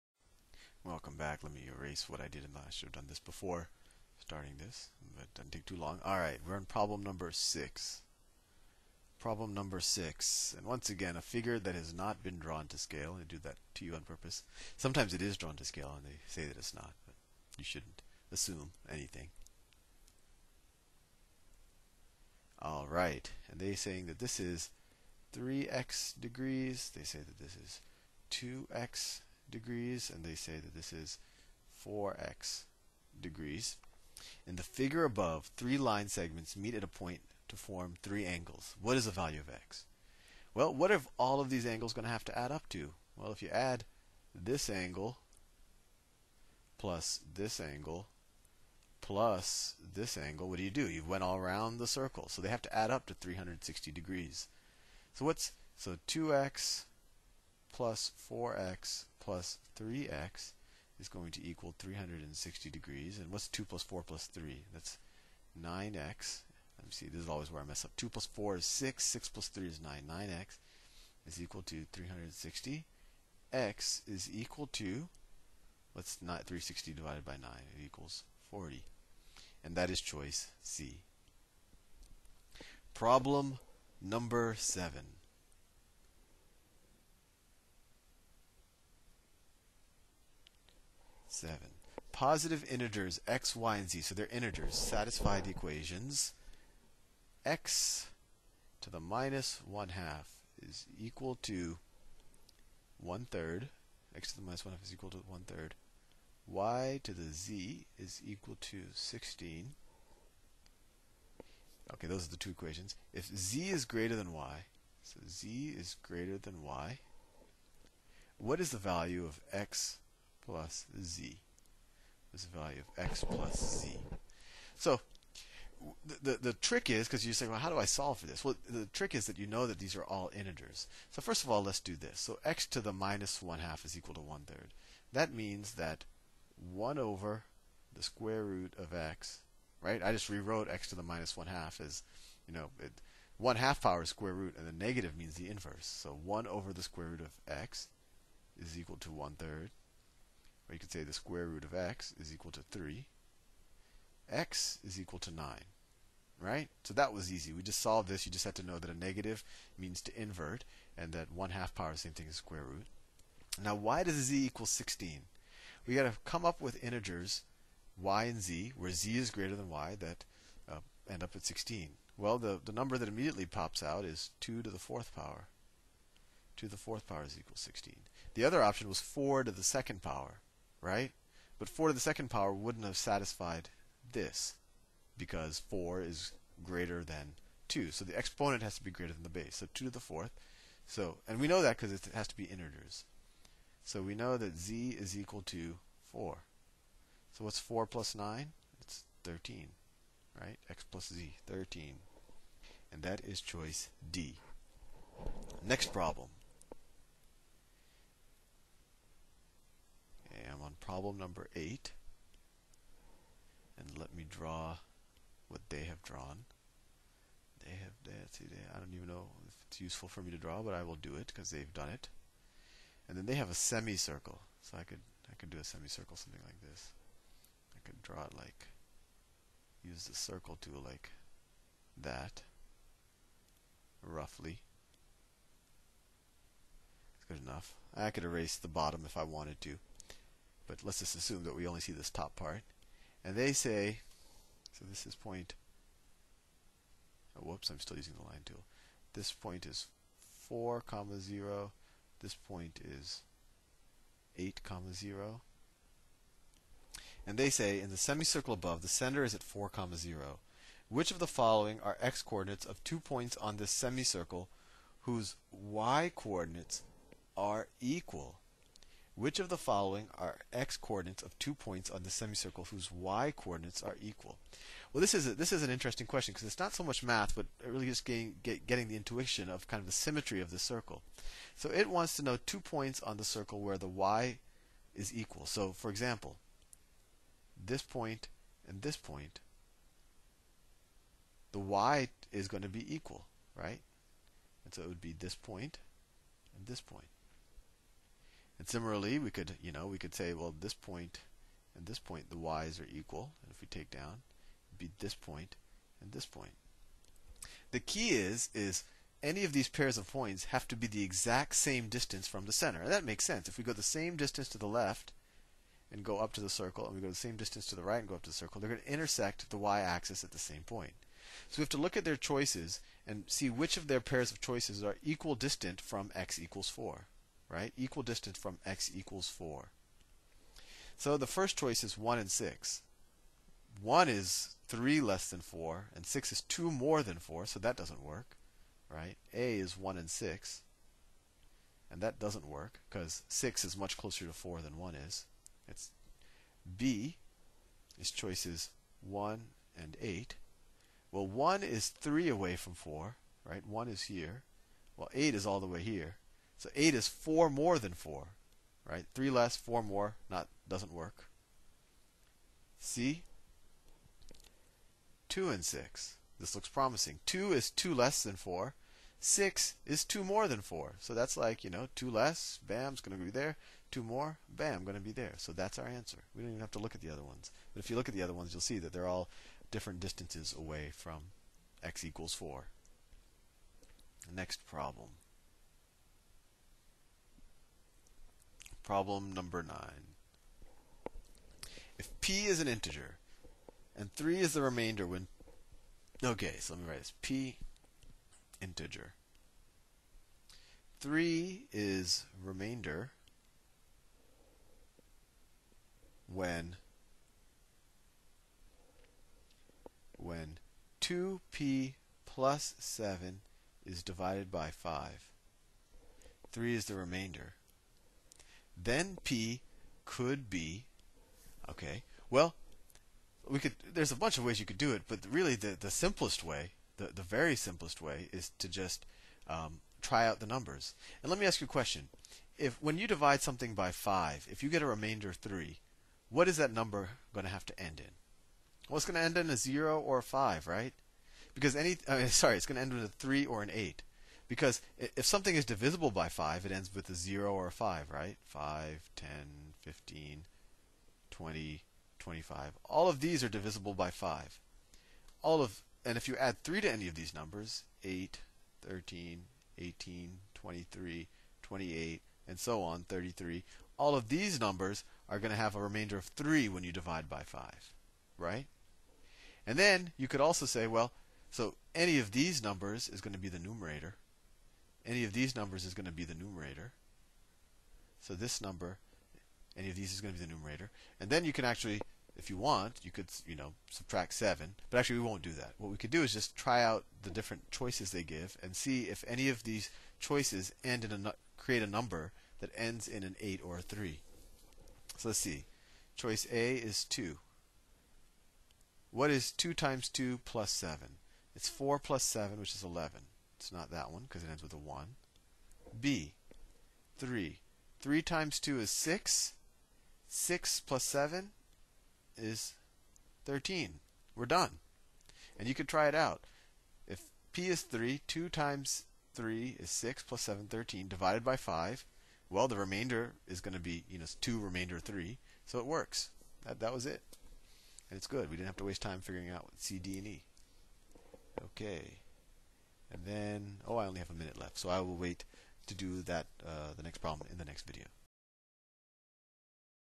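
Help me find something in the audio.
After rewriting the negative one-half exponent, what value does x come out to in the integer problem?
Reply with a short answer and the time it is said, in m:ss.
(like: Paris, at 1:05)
9, at 2:34.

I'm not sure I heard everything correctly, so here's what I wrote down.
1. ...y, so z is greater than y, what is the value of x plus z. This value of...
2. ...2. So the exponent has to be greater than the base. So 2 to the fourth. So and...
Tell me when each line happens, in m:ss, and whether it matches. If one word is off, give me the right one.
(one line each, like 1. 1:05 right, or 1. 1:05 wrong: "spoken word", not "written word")
1. 1:54 right
2. 3:07 right.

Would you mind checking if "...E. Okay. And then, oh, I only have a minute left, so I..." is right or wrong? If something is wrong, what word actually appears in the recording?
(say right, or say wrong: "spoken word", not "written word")
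right.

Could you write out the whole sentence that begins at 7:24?
Because if something is divisible by 5, it ends with a 0 or a 5, right?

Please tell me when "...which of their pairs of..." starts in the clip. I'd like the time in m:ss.
5:23.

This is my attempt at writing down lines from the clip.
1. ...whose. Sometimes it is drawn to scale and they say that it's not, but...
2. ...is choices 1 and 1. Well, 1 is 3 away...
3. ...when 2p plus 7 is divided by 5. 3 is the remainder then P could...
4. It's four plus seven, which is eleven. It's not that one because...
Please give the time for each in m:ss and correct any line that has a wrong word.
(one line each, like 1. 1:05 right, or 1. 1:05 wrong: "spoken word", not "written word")
1. 0:14 wrong: "purpose", not "whose"
2. 5:47 wrong: "8", not "1"
3. 6:50 right
4. 8:21 right.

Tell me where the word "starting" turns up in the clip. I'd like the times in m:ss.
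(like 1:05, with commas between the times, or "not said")
0:04.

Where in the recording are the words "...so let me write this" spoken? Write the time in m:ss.
6:36.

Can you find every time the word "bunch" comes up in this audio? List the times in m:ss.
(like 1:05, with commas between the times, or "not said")
7:04.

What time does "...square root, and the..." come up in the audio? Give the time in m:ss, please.
2:24.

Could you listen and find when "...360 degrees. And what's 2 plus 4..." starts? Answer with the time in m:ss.
1:01.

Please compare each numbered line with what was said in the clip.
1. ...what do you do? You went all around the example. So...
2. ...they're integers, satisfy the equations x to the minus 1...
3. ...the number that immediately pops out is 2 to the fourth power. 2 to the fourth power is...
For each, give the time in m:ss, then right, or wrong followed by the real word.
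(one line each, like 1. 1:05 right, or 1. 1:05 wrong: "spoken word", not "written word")
1. 0:50 wrong: "circle", not "example"
2. 1:34 right
3. 2:52 right.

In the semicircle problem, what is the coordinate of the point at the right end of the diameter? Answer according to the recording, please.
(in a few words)
8 comma 0.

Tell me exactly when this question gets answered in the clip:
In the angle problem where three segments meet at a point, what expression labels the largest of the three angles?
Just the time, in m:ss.
0:31.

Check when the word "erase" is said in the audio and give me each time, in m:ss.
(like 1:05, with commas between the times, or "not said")
0:01, 3:58.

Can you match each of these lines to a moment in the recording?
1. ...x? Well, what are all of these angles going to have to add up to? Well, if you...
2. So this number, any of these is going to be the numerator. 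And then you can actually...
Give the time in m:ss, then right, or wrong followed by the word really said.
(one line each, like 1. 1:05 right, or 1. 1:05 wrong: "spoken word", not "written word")
1. 0:39 right
2. 7:58 right.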